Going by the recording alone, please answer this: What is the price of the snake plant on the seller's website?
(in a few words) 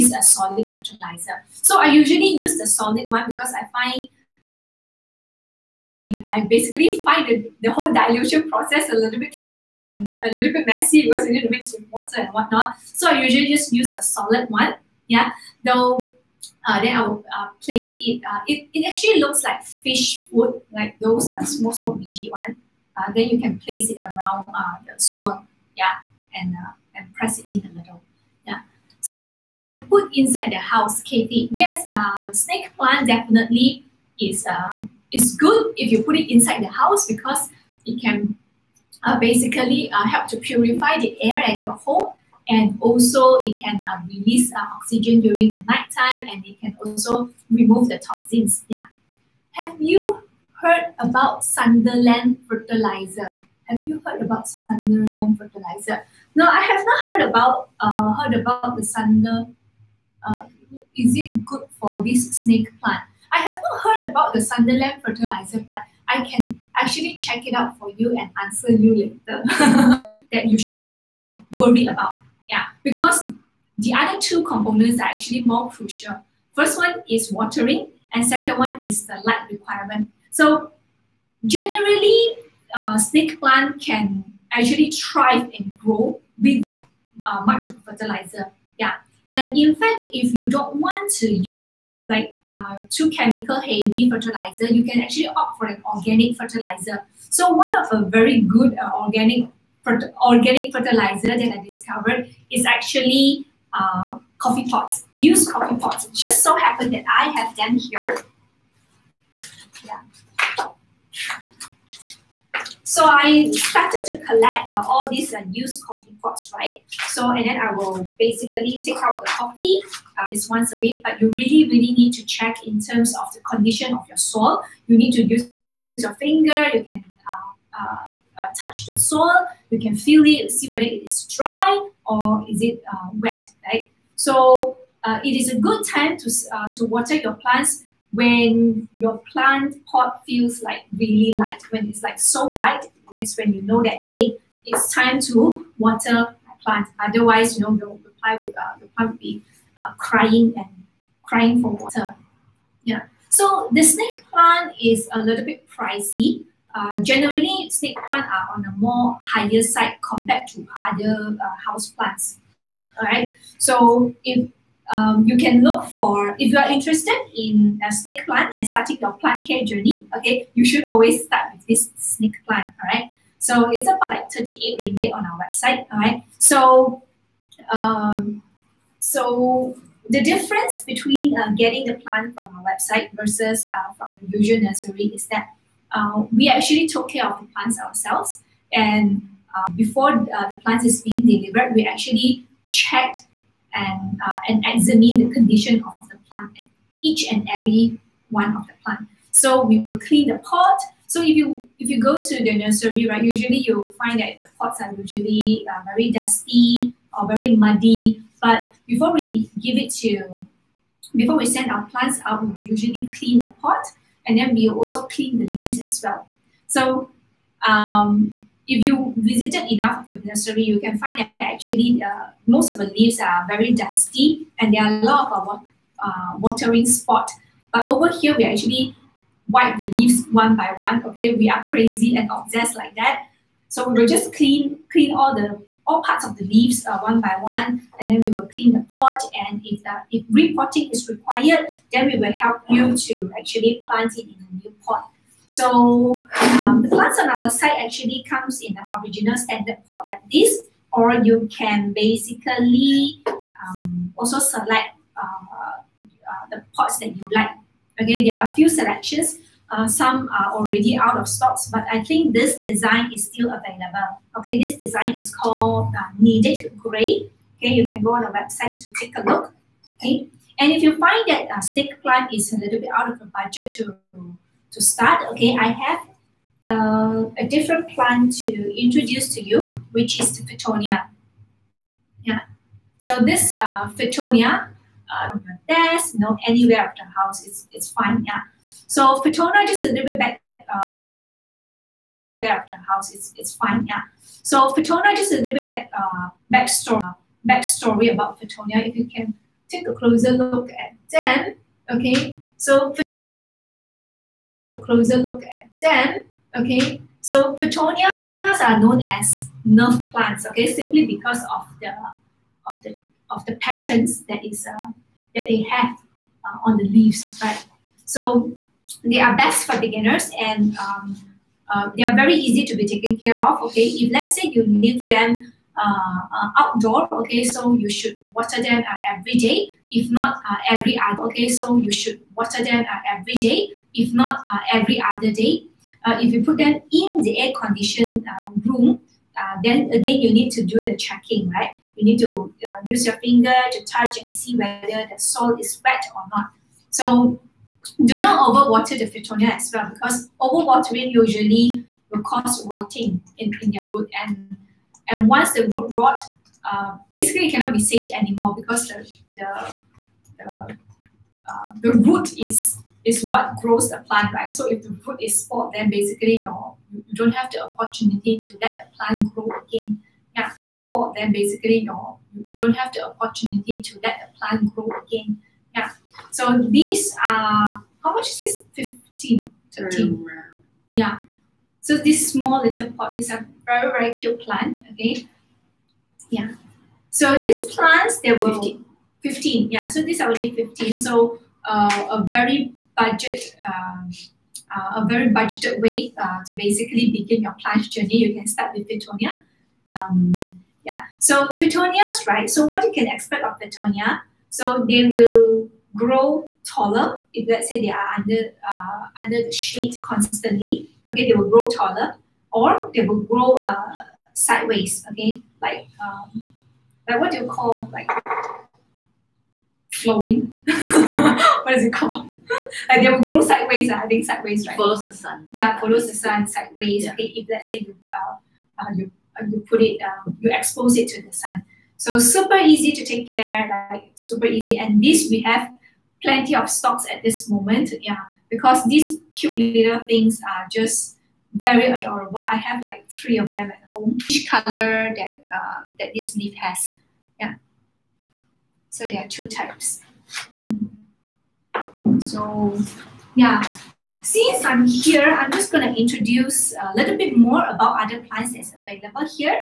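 38 ringgit.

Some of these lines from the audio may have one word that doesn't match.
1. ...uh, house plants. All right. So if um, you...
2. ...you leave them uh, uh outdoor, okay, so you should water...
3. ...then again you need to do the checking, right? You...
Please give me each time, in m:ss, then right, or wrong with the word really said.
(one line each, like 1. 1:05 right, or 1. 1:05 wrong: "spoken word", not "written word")
1. 2:41 right
2. 5:24 right
3. 5:39 right.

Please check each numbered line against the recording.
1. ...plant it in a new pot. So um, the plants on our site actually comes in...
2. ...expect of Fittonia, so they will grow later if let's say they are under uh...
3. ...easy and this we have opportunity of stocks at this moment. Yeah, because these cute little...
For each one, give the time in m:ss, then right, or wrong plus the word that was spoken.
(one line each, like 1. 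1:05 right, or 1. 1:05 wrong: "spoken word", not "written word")
1. 4:03 right
2. 6:43 wrong: "taller", not "later"
3. 7:14 wrong: "plenty", not "opportunity".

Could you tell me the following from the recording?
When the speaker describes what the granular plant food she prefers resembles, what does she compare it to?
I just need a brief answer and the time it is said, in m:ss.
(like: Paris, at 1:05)
Fish food, at 0:19.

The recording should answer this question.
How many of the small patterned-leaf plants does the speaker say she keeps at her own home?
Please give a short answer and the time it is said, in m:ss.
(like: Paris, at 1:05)
3, at 7:23.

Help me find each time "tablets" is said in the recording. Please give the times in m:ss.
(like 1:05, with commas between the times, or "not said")
not said.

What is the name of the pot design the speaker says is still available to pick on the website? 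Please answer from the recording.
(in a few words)
Needed Gray.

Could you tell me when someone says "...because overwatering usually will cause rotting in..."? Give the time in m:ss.
5:49.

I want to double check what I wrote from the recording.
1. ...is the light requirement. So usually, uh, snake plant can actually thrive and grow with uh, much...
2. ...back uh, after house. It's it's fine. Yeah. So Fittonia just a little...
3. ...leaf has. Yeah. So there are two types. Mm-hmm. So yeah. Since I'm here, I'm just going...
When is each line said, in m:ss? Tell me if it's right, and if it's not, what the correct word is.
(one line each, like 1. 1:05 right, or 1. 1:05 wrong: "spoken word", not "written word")
1. 1:18 wrong: "generally", not "usually"
2. 4:50 right
3. 7:26 right.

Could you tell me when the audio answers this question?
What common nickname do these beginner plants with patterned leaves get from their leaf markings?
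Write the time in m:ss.
5:09.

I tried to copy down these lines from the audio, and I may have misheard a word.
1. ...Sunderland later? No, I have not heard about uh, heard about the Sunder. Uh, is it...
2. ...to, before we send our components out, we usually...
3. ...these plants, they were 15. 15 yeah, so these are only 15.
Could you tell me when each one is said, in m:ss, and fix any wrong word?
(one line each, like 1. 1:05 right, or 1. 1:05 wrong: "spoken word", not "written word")
1. 0:54 wrong: "fertilizer", not "later"
2. 3:29 wrong: "plants", not "components"
3. 6:27 right.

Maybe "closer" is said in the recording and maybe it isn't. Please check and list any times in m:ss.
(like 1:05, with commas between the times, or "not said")
4:59, 5:04.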